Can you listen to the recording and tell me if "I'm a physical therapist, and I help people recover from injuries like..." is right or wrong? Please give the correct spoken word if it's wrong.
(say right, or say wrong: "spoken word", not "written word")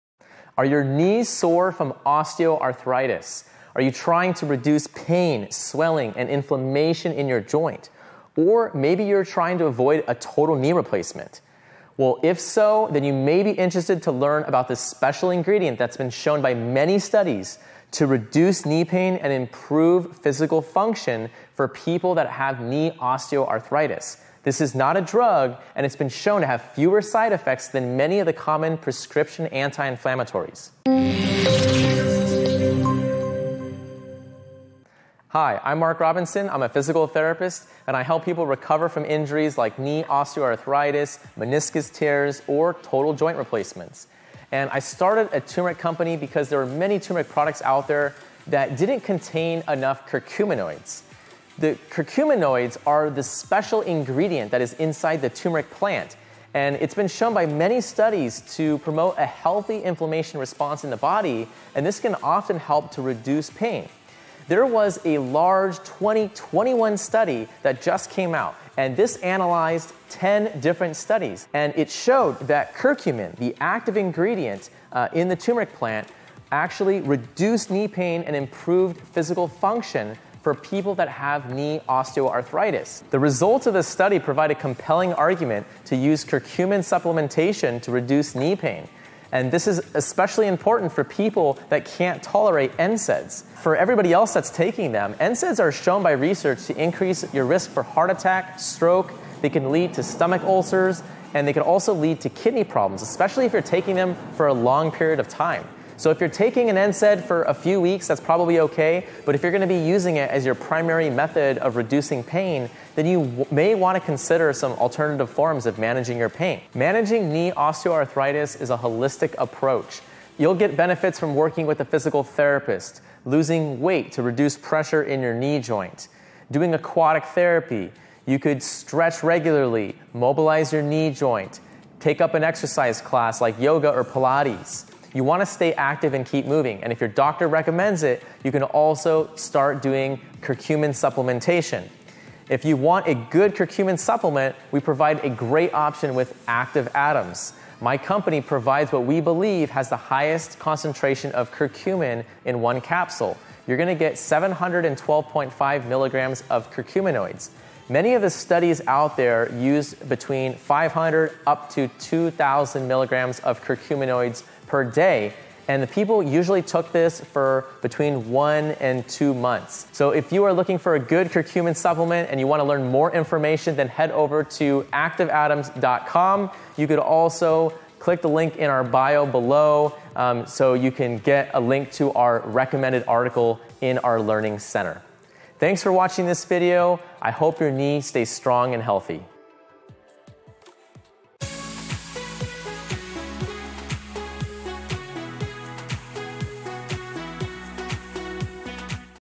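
right.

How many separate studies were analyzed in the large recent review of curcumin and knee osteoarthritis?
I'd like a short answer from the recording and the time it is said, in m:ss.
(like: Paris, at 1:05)
10, at 1:10.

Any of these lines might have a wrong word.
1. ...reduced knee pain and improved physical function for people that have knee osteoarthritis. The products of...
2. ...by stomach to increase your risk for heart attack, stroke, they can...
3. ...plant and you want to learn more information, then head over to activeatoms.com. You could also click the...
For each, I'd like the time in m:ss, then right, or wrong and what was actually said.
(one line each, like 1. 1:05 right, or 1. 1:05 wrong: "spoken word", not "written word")
1. 1:17 wrong: "results", not "products"
2. 1:36 wrong: "research", not "stomach"
3. 2:51 wrong: "supplement", not "plant".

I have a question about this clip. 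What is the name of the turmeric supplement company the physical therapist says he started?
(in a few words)
Active Atoms.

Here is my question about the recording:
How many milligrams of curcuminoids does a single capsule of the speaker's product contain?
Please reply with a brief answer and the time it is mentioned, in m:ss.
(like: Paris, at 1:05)
712.5 milligrams, at 2:34.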